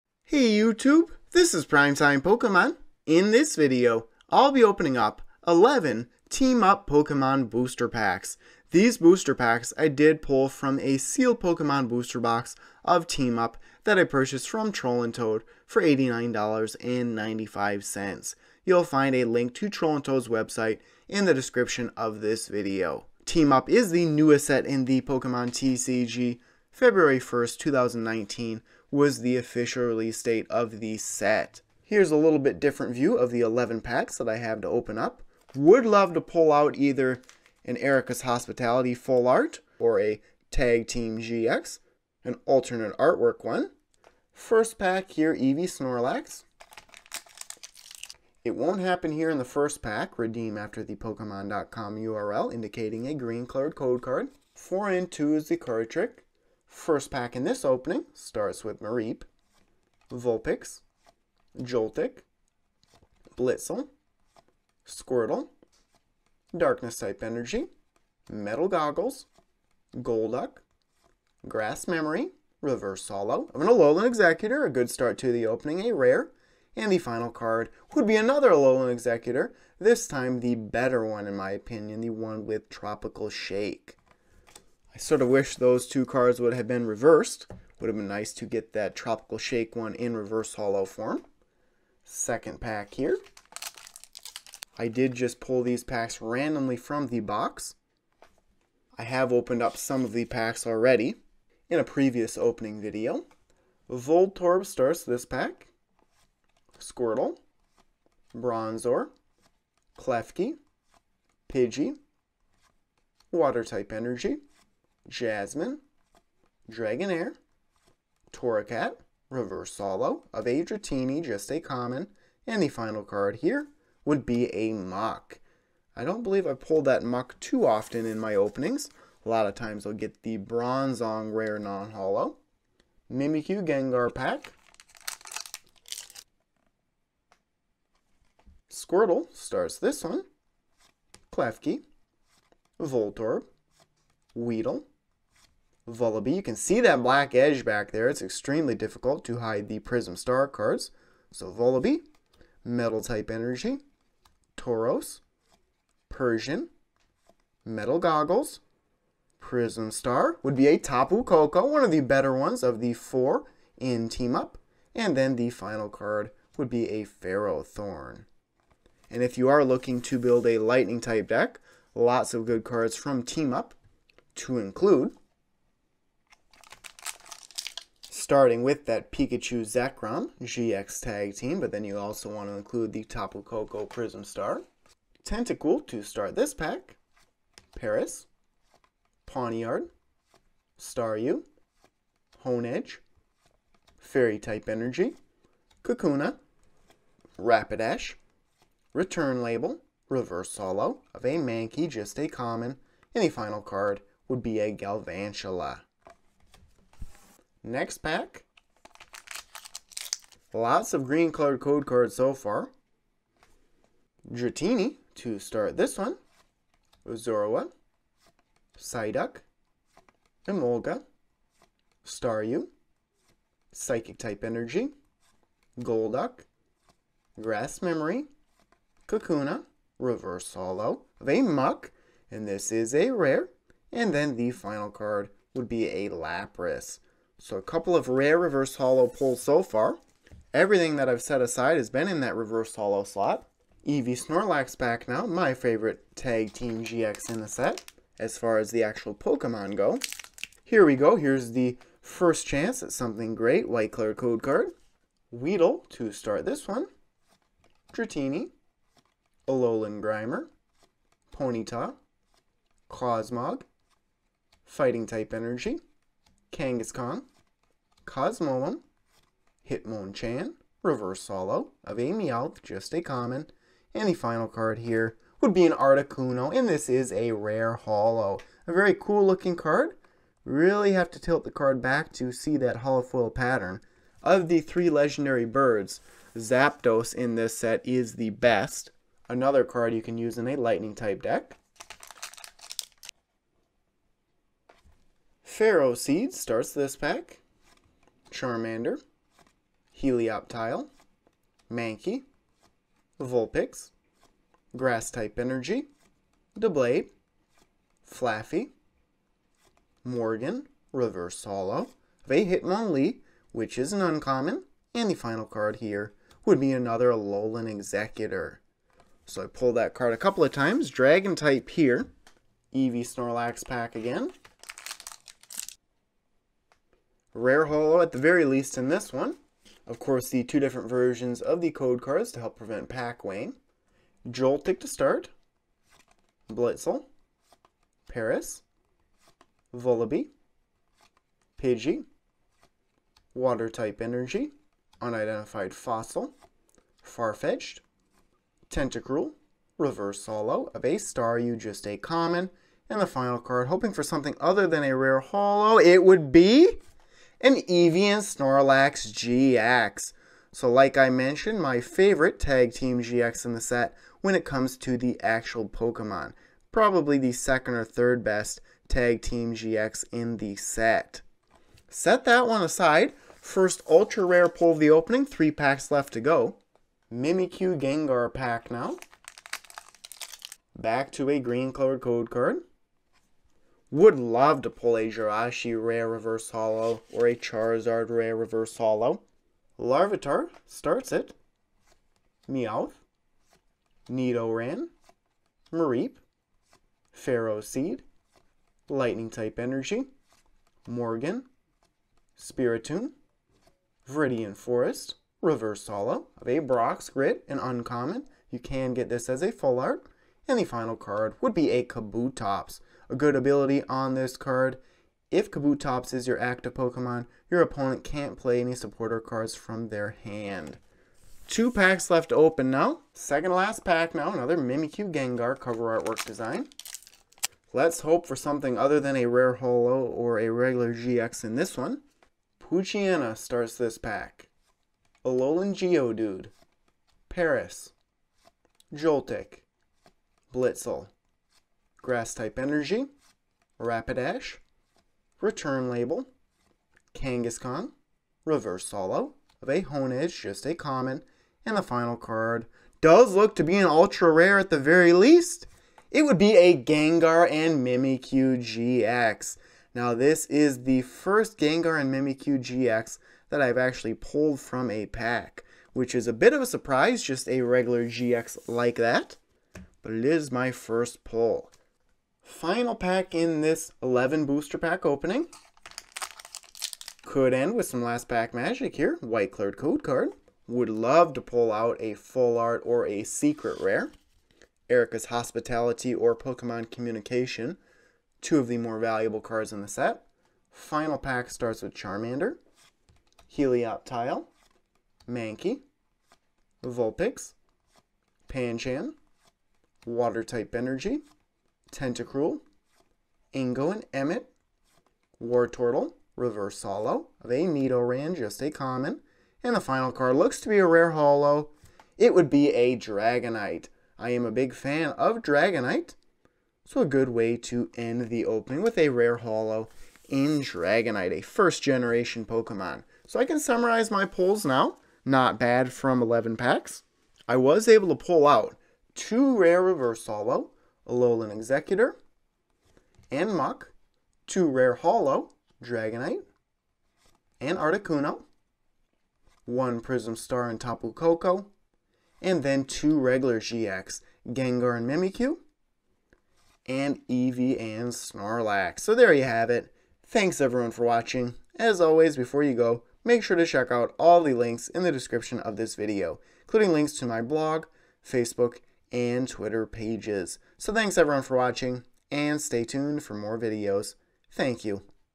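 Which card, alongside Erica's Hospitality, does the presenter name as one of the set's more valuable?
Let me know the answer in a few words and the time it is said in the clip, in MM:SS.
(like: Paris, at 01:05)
Pokemon Communication, at 08:06.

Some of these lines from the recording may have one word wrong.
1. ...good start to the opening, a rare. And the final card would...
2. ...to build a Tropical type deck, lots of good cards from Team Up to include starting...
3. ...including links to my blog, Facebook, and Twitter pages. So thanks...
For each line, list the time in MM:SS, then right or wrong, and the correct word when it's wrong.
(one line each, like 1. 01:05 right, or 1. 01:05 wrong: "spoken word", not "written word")
1. 01:14 right
2. 02:50 wrong: "Lightning", not "Tropical"
3. 09:16 right.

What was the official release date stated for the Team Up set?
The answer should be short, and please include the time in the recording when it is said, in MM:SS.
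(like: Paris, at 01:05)
February 1st, 2019, at 00:26.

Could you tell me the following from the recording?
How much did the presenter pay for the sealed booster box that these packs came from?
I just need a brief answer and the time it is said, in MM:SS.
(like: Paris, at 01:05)
$89.95, at 00:15.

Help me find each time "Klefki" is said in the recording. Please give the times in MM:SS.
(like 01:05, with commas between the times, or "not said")
01:49, 02:21.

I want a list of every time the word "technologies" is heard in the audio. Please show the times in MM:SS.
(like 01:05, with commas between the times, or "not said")
not said.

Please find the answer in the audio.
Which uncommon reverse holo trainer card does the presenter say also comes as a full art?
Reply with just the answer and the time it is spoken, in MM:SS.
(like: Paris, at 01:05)
Brock's Grit, at 06:46.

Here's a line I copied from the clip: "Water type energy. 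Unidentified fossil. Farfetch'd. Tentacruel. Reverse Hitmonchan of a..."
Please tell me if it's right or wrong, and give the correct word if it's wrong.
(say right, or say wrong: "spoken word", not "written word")
wrong: "Holo", not "Hitmonchan".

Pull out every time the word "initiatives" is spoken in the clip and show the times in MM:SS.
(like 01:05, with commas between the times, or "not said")
not said.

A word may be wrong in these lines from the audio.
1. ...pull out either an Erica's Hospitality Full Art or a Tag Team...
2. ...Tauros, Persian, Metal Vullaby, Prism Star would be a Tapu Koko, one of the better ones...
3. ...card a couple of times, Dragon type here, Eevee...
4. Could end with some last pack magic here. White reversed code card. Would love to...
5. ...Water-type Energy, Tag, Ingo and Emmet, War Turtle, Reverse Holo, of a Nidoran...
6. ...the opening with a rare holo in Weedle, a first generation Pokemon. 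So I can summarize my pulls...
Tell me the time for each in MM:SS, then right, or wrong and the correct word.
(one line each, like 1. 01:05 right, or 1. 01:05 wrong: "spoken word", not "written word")
1. 00:36 right
2. 02:34 wrong: "Goggles", not "Vullaby"
3. 05:19 right
4. 07:57 wrong: "colored", not "reversed"
5. 08:20 wrong: "Tentacruel", not "Tag"
6. 08:38 wrong: "Dragonite", not "Weedle".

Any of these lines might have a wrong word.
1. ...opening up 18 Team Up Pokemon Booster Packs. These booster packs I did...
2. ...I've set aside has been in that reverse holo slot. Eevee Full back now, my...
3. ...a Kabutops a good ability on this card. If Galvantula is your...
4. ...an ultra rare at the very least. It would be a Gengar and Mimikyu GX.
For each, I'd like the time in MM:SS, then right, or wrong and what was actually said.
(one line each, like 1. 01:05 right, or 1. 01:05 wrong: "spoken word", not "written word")
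1. 00:04 wrong: "11", not "18"
2. 04:01 wrong: "Snorlax", not "Full"
3. 06:51 wrong: "Kabutops", not "Galvantula"
4. 07:33 right.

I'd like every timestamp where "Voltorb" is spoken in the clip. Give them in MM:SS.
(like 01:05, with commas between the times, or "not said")
01:43, 02:22.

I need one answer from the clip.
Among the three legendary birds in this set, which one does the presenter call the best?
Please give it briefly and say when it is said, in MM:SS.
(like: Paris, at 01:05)
Zapdos, at 04:46.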